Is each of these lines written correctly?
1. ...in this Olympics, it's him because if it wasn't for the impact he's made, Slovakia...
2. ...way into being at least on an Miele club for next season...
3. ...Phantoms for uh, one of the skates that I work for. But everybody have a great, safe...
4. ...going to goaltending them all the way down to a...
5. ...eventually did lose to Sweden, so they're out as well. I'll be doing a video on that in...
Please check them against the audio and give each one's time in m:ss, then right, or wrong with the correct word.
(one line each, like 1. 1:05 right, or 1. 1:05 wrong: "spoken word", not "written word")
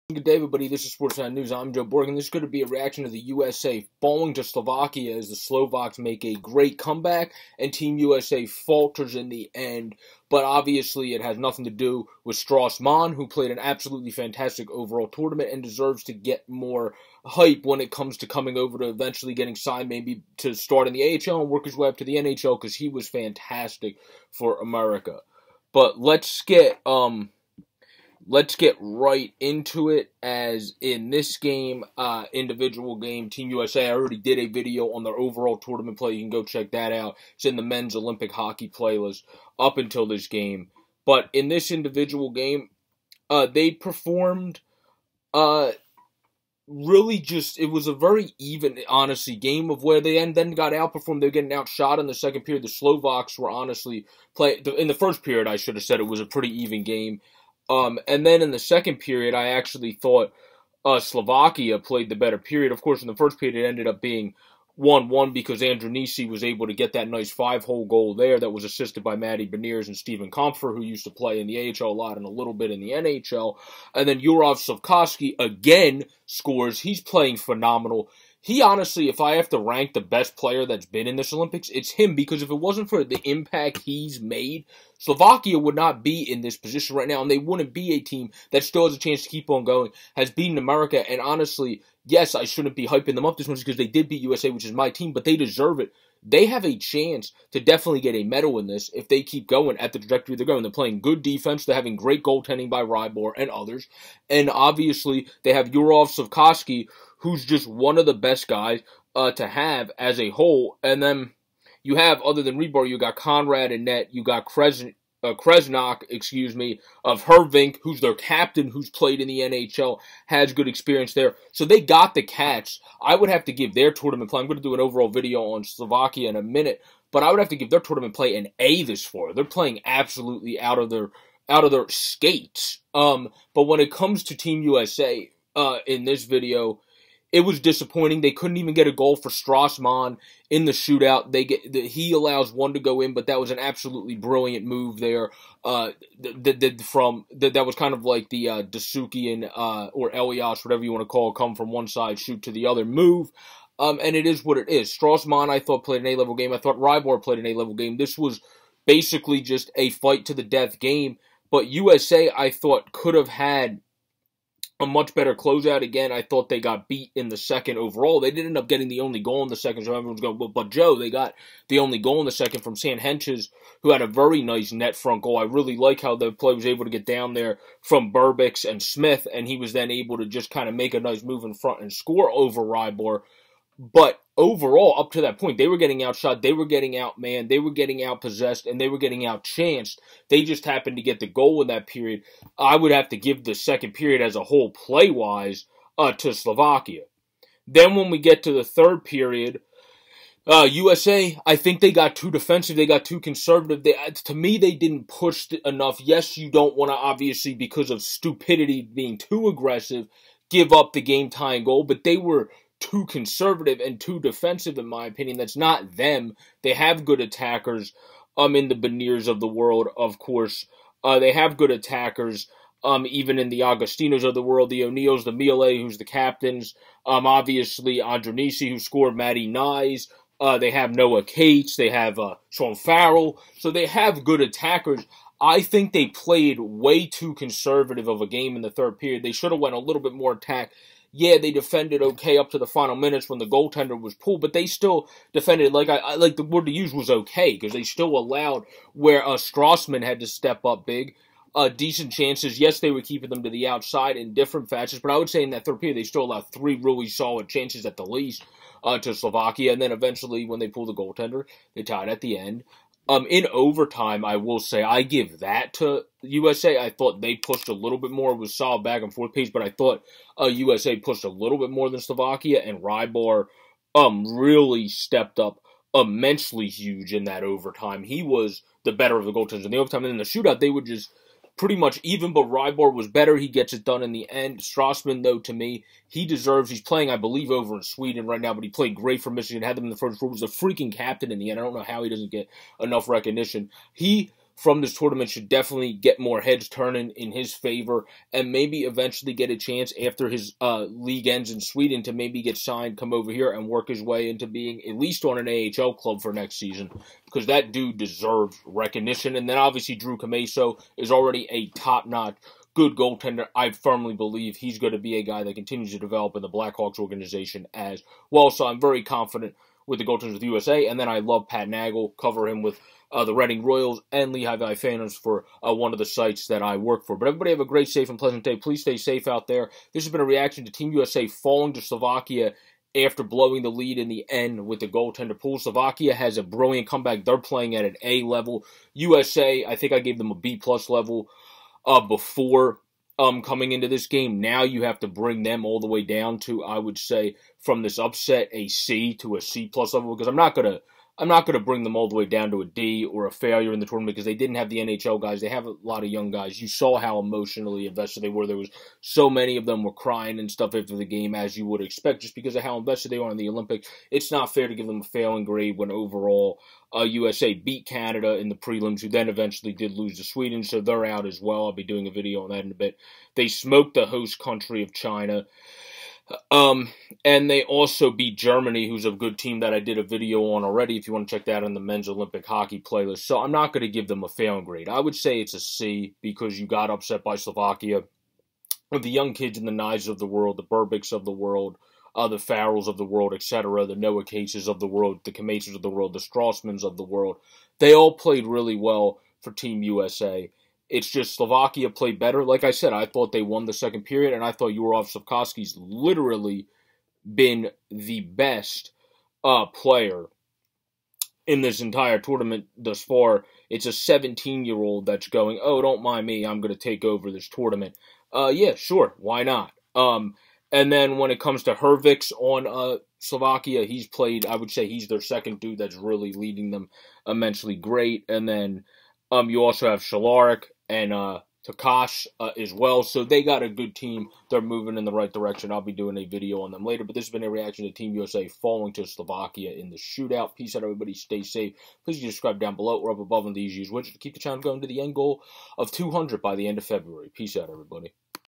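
1. 1:21 right
2. 5:04 wrong: "AHL", not "Miele"
3. 5:24 wrong: "sites", not "skates"
4. 5:51 wrong: "bring", not "goaltending"
5. 6:09 right.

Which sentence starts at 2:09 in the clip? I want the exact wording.
They're playing absolutely out of their out of their skates.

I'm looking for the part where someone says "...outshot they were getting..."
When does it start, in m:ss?
3:06.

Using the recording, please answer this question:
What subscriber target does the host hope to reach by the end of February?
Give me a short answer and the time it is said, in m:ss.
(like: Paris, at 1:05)
200, at 7:25.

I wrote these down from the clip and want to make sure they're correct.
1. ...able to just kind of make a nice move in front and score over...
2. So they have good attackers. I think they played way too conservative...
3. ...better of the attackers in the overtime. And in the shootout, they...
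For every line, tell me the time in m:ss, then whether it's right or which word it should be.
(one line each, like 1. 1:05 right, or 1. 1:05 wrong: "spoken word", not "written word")
1. 2:59 right
2. 3:53 right
3. 4:38 wrong: "goaltenders", not "attackers".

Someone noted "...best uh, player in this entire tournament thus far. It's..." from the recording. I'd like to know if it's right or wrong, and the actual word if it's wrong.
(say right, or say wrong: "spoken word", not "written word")
right.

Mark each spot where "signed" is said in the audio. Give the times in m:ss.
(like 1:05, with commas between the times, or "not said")
0:19, 5:02.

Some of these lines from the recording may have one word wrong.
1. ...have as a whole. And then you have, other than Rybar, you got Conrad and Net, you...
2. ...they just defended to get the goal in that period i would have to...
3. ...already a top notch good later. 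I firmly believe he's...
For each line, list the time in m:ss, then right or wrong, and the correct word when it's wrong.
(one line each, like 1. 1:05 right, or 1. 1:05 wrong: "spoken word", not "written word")
1. 1:49 right
2. 3:10 wrong: "happened", not "defended"
3. 5:11 wrong: "goaltender", not "later".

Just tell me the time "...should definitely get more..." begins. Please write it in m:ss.
4:55.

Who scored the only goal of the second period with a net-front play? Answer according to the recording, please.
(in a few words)
Sam Hentges.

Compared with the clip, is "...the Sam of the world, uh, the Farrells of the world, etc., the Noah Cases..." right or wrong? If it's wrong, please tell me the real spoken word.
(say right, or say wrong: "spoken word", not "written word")
wrong: "Burbicks", not "Sam".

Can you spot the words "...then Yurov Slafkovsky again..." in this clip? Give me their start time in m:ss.
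1:14.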